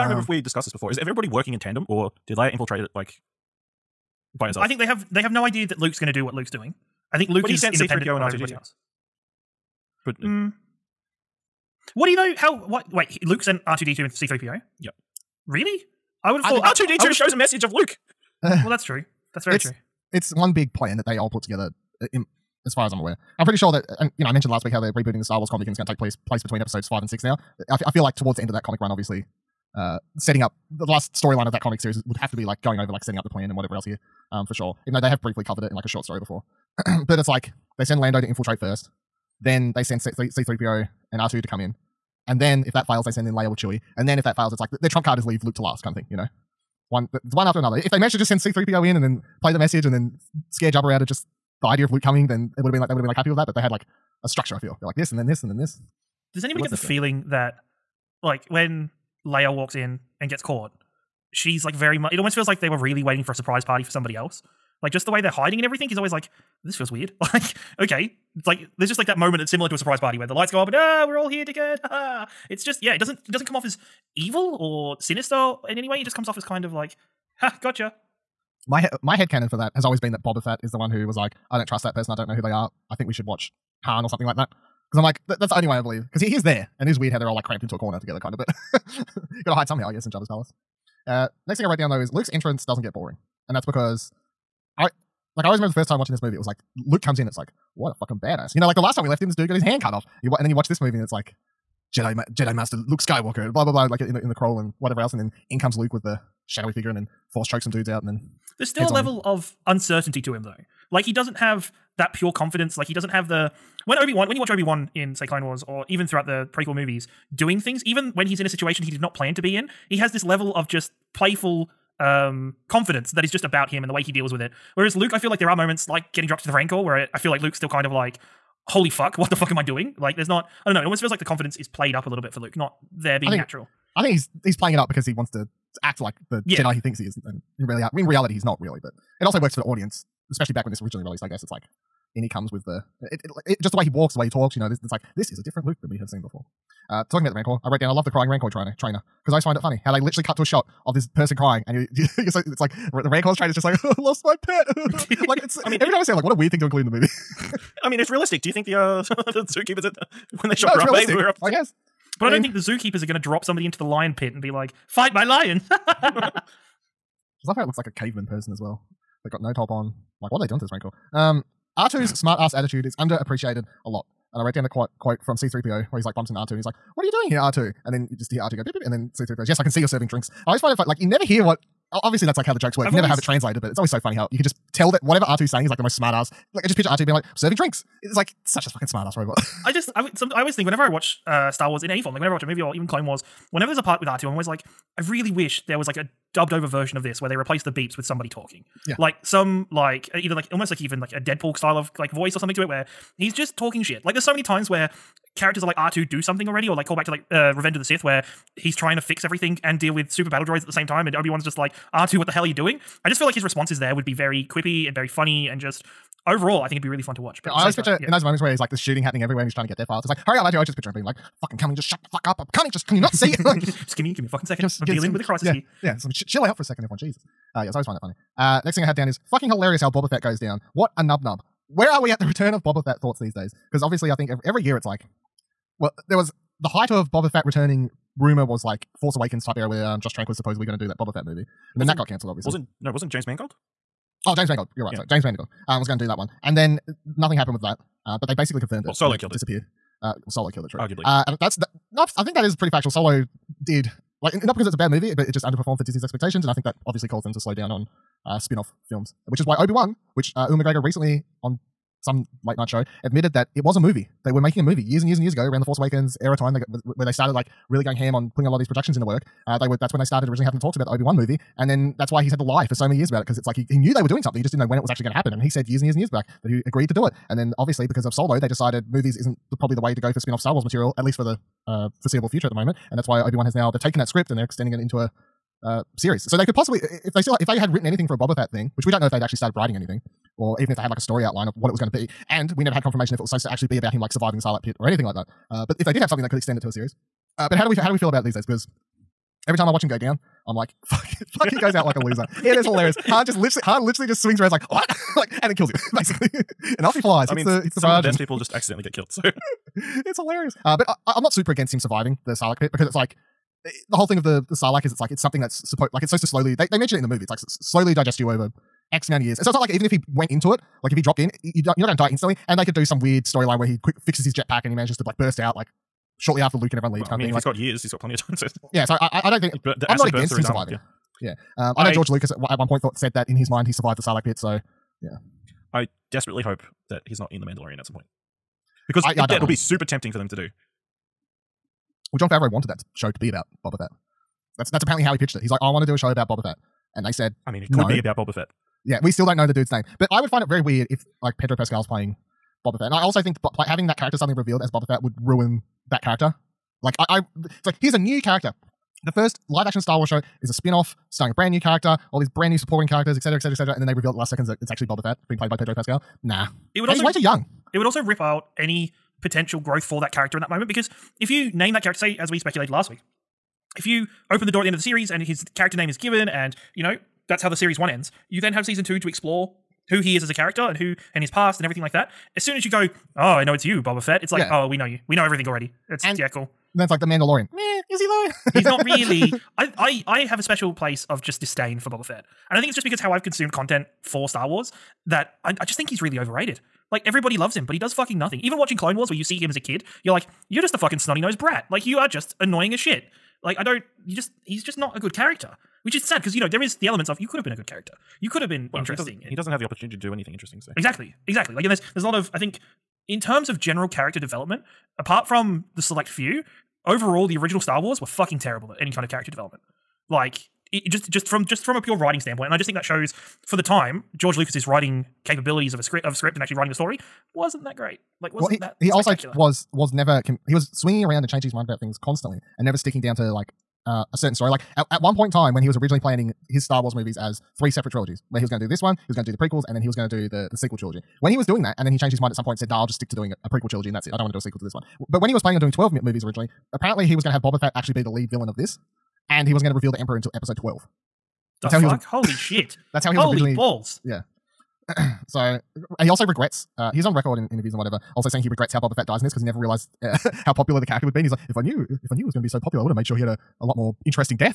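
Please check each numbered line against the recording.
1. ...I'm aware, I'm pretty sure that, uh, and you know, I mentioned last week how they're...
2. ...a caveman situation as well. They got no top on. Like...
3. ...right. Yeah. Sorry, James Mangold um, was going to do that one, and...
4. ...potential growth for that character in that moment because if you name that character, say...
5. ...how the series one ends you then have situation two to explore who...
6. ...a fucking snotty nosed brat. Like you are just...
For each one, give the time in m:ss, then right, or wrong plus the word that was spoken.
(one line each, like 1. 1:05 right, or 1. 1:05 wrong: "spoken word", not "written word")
1. 0:22 right
2. 2:47 wrong: "person", not "situation"
3. 4:04 right
4. 6:09 right
5. 6:17 wrong: "season", not "situation"
6. 6:40 right.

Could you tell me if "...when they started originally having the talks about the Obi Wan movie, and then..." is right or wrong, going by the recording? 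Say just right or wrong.
right.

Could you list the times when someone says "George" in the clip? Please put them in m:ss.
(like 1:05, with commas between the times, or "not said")
5:31, 7:04.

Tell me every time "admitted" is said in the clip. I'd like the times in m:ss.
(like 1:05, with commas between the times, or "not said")
4:23.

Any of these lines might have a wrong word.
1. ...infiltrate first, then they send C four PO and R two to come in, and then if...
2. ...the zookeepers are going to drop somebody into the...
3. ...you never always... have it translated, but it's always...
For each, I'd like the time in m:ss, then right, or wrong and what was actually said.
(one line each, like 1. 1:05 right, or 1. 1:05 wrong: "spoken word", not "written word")
1. 0:38 wrong: "three", not "four"
2. 2:42 right
3. 3:02 right.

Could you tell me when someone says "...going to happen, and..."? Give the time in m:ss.
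4:35.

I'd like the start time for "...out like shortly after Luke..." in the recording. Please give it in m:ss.
5:25.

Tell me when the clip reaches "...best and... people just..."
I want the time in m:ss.
5:08.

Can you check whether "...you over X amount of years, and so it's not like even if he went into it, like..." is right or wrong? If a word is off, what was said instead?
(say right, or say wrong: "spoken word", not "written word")
right.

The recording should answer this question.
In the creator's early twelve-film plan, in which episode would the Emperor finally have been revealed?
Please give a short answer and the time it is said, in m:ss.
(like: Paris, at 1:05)
Episode 12, at 7:30.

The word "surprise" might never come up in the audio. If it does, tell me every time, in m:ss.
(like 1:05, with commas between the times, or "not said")
1:03, 1:09.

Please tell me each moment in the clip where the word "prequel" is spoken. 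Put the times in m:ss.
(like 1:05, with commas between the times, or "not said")
1:56, 7:19, 7:23.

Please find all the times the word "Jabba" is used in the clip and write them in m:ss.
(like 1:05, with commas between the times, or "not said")
0:50, 1:30.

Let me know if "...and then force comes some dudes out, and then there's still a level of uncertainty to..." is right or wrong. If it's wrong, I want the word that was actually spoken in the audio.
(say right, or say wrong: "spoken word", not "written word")
wrong: "chokes", not "comes".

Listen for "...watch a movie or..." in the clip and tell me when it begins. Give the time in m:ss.
3:12.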